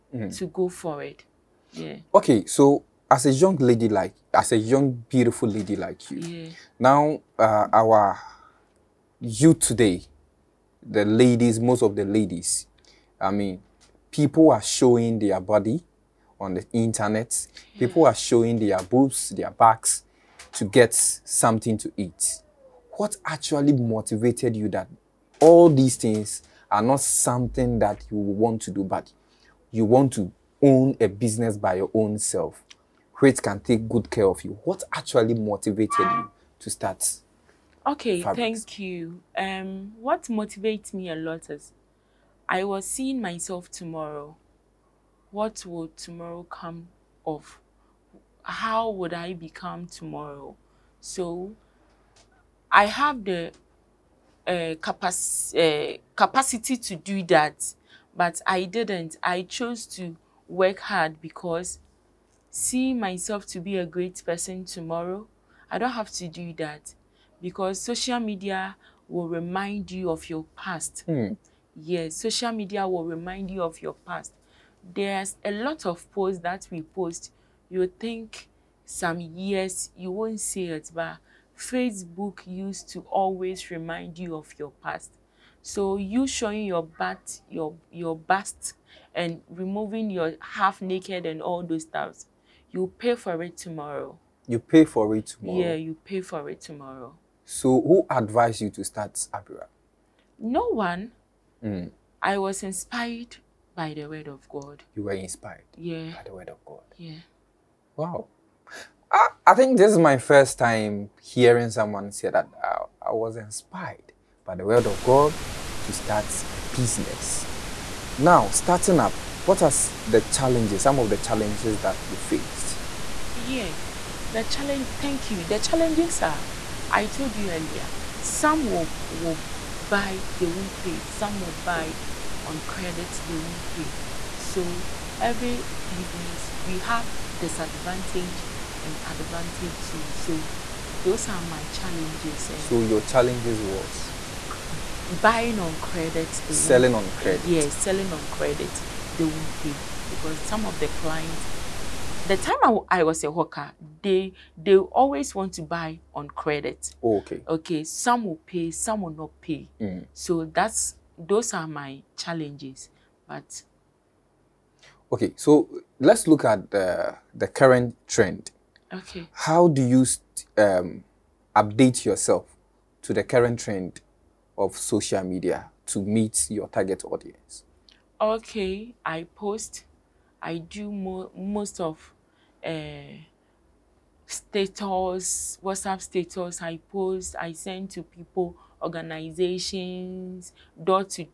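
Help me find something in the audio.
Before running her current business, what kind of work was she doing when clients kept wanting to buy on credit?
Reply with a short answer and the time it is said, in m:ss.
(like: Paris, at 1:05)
Hawker, at 2:33.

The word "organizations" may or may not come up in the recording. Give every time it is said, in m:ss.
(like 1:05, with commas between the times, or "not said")
3:08.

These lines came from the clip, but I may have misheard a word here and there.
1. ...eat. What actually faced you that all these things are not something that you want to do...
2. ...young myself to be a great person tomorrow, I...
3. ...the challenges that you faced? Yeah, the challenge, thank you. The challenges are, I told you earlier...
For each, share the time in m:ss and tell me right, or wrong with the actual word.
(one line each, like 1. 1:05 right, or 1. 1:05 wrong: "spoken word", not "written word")
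1. 0:21 wrong: "motivated", not "faced"
2. 1:02 wrong: "seeing", not "young"
3. 2:01 right.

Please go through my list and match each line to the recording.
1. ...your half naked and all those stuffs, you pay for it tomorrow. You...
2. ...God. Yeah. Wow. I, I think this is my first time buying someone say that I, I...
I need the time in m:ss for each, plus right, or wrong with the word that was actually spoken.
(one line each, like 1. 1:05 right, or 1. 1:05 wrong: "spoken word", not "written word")
1. 1:30 right
2. 1:46 wrong: "hearing", not "buying".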